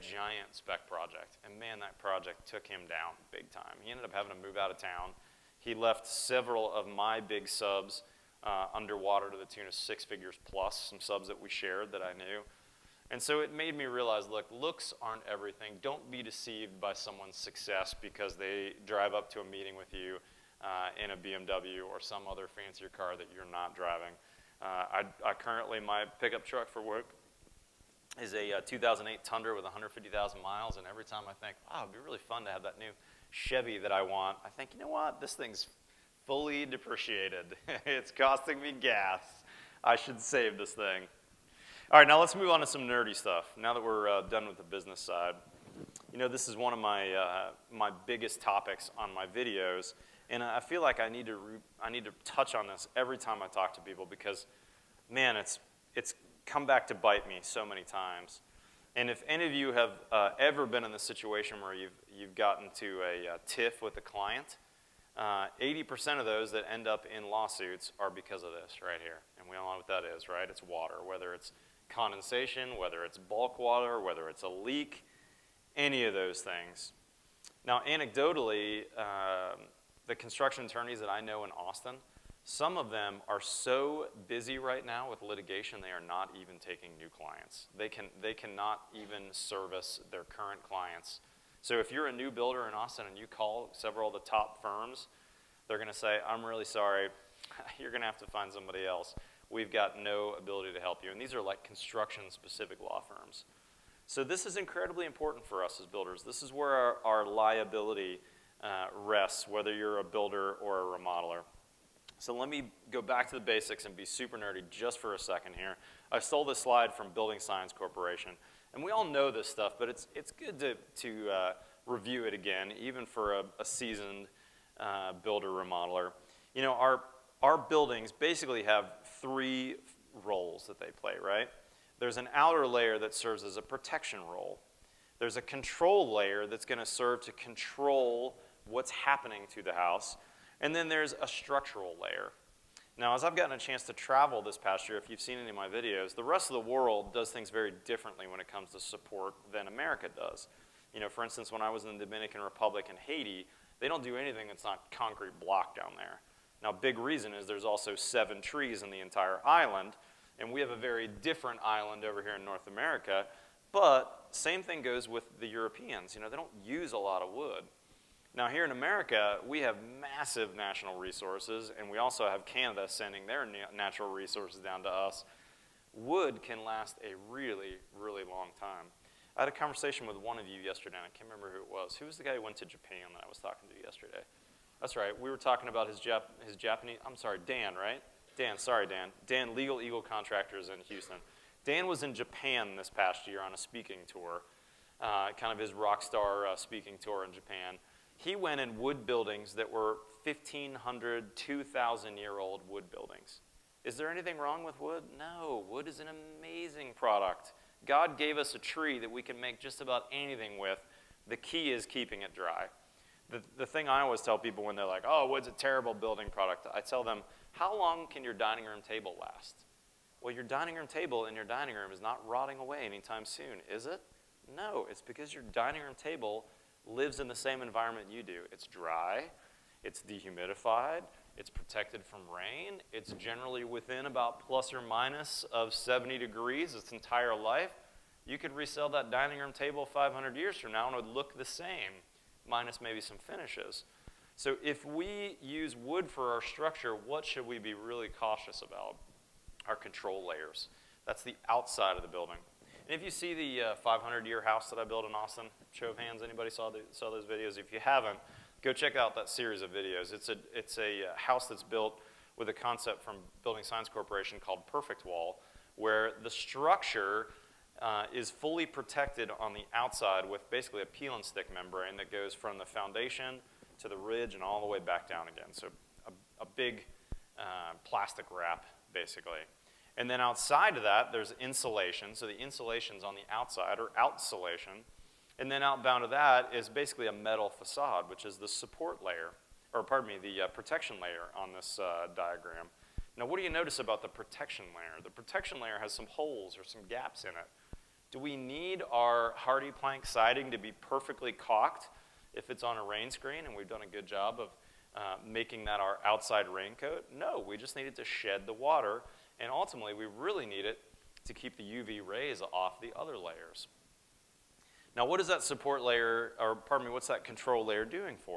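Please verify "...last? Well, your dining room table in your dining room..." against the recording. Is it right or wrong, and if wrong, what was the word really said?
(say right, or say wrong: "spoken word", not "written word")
right.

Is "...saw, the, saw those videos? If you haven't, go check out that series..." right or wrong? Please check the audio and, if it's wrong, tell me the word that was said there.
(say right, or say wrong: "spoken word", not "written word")
right.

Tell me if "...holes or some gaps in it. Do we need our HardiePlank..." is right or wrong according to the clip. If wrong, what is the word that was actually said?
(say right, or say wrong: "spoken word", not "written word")
right.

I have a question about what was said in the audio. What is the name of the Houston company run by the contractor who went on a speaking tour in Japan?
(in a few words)
Legal Eagle Contractors.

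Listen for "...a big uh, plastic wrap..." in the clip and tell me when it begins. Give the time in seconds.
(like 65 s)
276 s.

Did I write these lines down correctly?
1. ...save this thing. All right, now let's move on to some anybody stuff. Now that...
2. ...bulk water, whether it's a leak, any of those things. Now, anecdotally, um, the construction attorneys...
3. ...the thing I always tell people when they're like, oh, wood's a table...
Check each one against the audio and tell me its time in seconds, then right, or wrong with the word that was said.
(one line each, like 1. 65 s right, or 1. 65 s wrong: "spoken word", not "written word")
1. 40 s wrong: "nerdy", not "anybody"
2. 73 s right
3. 213 s wrong: "terrible", not "table".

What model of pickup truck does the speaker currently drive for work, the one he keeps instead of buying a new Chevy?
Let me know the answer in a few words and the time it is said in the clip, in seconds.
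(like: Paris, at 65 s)
2008 Tundra, at 28 s.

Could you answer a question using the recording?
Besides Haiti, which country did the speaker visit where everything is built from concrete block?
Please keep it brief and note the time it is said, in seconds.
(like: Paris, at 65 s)
Dominican Republic, at 152 s.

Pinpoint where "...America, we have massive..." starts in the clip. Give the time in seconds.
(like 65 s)
168 s.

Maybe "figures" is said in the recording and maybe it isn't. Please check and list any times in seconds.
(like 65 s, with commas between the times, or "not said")
10 s.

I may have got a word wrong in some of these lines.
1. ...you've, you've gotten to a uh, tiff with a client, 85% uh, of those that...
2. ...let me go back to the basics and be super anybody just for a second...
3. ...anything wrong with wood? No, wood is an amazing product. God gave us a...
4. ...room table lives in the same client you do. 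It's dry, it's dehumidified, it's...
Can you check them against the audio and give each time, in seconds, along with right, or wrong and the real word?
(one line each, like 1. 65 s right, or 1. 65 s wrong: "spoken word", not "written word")
1. 61 s wrong: "80", not "85"
2. 112 s wrong: "nerdy", not "anybody"
3. 204 s right
4. 225 s wrong: "environment", not "client".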